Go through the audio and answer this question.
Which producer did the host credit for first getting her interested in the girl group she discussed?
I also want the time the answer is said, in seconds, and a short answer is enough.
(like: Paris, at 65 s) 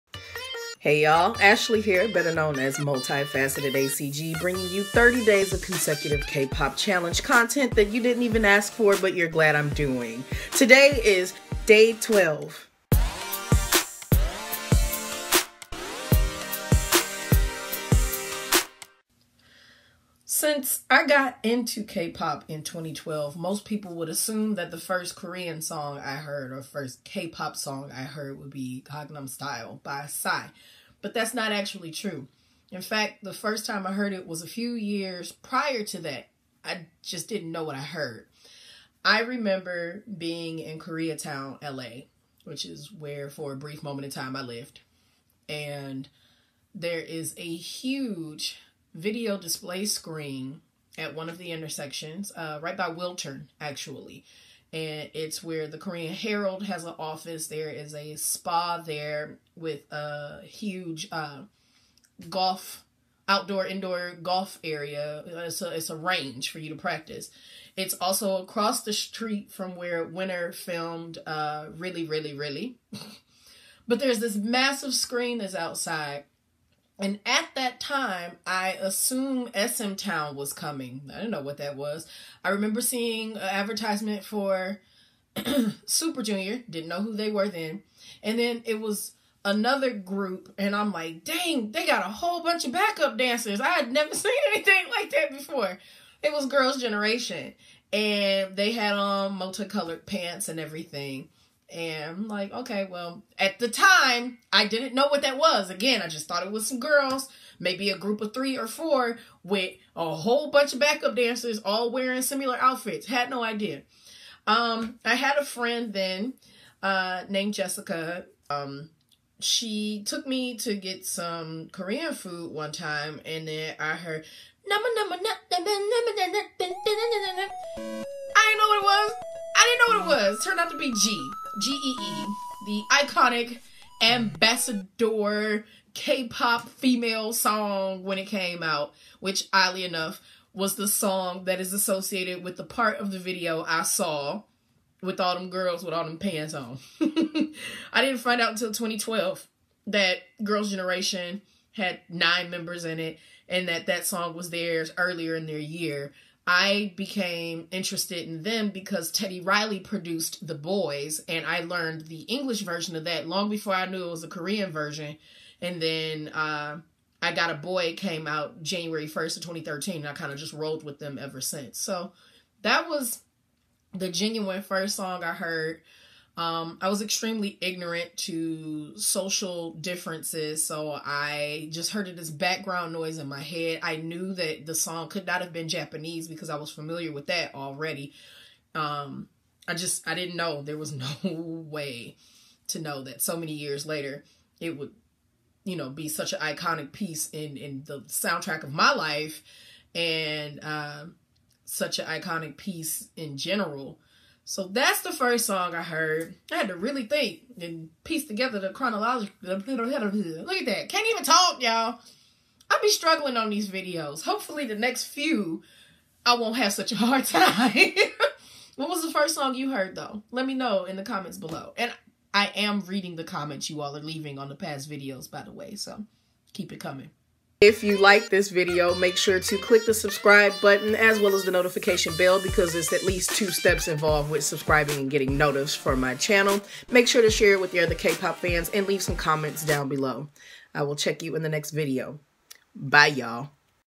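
Teddy Riley, at 159 s.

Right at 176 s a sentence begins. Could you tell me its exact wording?
Um, I was extremely ignorant to social differences, so I just heard this background noise in my head.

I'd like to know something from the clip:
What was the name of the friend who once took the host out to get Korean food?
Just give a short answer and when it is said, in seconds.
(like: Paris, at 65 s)
Jessica, at 117 s.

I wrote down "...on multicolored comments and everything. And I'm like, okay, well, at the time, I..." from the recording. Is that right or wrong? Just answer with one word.
wrong.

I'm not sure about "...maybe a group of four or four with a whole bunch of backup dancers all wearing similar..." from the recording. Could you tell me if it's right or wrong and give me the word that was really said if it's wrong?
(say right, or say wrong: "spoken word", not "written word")
wrong: "three", not "four".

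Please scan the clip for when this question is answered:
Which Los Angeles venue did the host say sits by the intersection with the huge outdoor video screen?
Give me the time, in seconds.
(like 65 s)
52 s.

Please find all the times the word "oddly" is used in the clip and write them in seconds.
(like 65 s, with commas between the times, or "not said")
139 s.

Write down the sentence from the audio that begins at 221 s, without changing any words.
And I am reading the comments you all are leaving on the past videos, by the way.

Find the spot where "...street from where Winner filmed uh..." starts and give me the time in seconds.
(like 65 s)
68 s.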